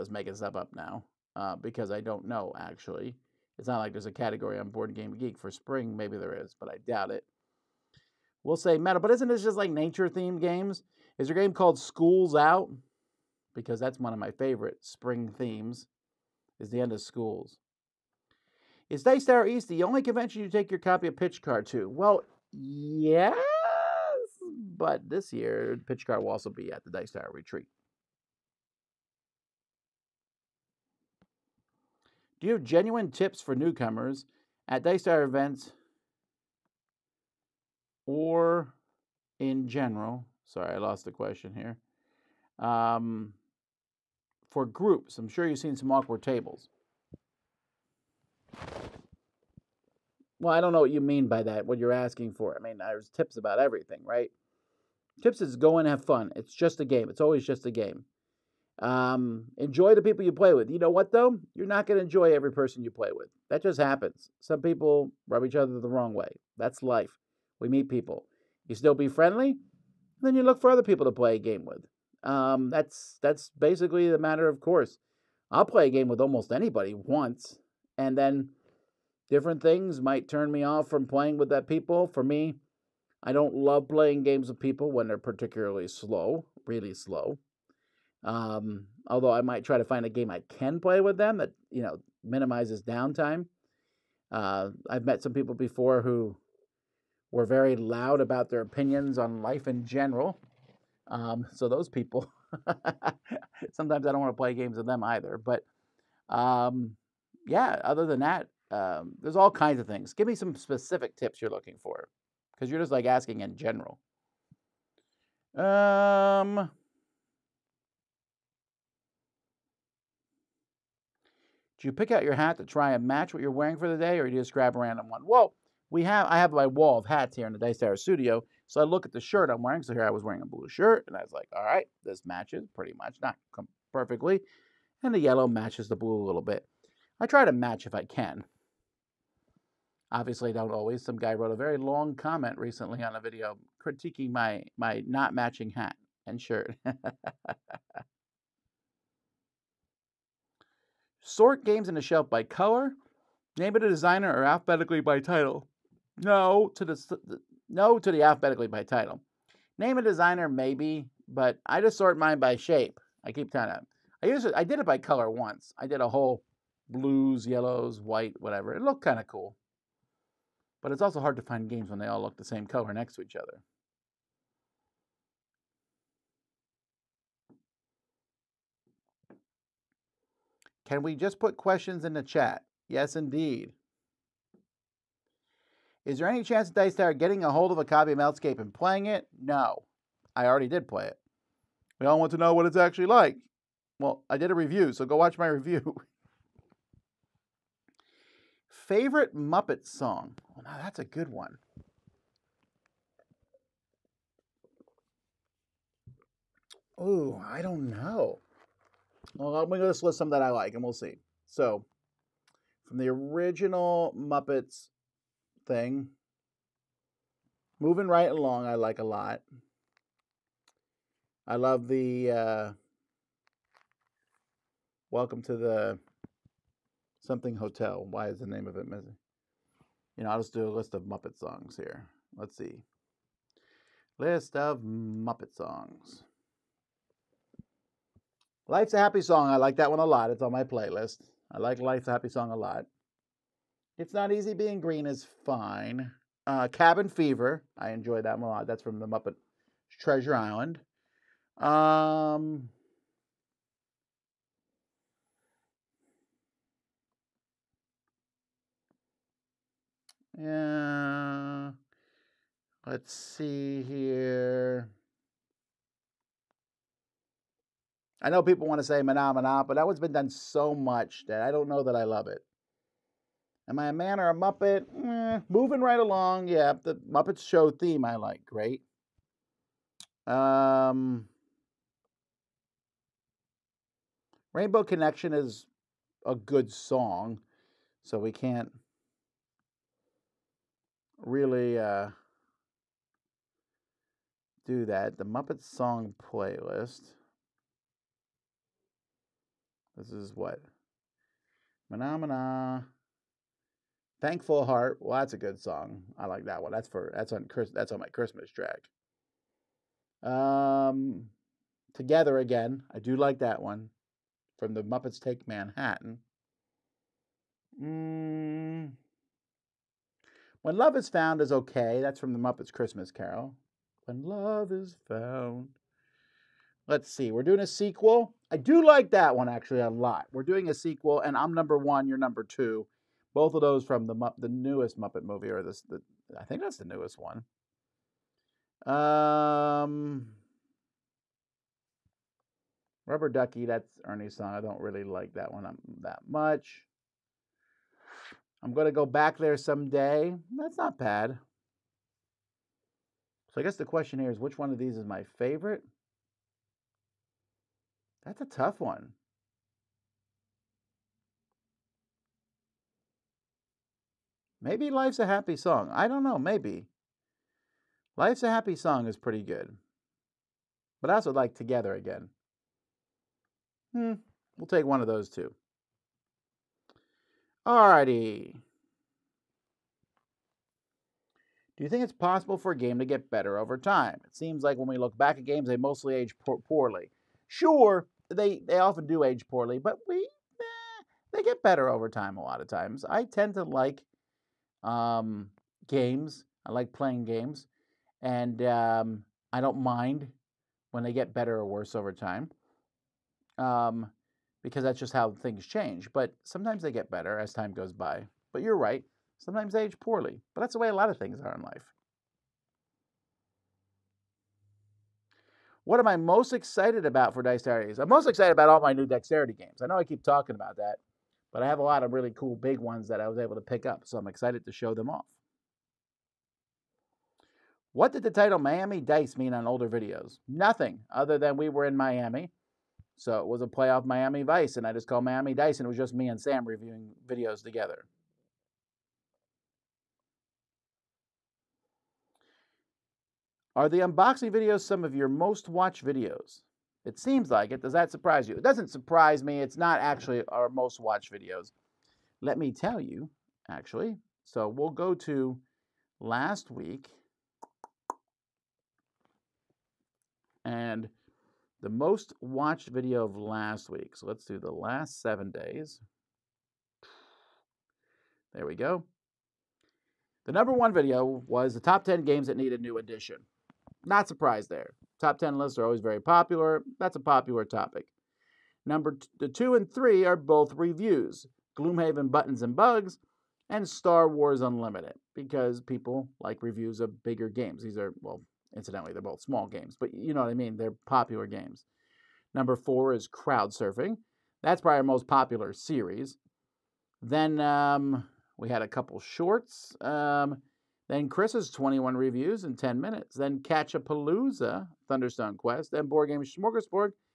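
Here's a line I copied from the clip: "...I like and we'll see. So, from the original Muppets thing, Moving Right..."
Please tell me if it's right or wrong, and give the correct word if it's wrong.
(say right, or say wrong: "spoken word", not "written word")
right.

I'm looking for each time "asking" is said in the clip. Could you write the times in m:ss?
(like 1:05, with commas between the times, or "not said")
0:51, 1:53.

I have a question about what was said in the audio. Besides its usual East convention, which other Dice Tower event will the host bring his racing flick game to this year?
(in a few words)
Dice Tower Retreat.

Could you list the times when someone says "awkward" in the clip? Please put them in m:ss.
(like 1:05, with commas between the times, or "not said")
0:45.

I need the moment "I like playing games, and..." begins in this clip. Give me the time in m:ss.
6:36.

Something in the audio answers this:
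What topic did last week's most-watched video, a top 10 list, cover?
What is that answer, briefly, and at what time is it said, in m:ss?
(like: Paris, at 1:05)
games that need a new edition, at 7:52.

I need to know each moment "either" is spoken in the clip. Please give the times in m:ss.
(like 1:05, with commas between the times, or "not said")
1:45.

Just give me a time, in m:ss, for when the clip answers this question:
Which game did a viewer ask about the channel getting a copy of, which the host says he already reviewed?
3:08.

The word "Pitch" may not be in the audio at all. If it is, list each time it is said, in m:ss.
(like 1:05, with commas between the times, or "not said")
0:21, 0:25.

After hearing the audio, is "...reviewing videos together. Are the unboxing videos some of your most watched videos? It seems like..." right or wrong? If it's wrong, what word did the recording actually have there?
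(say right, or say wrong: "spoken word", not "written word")
right.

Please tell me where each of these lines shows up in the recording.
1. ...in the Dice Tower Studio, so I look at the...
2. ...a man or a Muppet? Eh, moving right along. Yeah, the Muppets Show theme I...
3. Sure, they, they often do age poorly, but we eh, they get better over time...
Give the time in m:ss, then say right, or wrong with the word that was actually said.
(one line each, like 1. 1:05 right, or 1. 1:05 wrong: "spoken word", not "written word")
1. 2:07 right
2. 4:33 right
3. 6:27 right.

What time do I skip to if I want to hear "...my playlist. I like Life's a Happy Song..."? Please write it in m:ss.
4:00.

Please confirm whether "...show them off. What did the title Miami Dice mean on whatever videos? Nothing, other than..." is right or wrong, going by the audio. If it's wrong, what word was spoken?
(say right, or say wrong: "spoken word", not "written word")
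wrong: "older", not "whatever".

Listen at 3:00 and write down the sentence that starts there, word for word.
Can we just put questions in the chat?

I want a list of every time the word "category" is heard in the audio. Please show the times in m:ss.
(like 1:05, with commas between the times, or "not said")
0:04.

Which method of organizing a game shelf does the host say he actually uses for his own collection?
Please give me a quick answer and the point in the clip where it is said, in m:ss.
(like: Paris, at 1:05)
by shape, at 2:42.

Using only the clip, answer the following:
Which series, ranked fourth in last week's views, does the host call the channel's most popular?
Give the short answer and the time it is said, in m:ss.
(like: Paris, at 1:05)
Crowd surfing, at 8:13.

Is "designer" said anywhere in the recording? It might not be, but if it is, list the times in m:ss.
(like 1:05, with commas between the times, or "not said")
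2:33, 2:40.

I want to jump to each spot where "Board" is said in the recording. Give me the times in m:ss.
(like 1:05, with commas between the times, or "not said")
0:04, 8:26.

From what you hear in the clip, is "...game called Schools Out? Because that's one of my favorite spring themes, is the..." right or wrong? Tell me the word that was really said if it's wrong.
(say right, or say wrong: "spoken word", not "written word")
right.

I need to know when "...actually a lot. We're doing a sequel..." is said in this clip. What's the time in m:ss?
5:29.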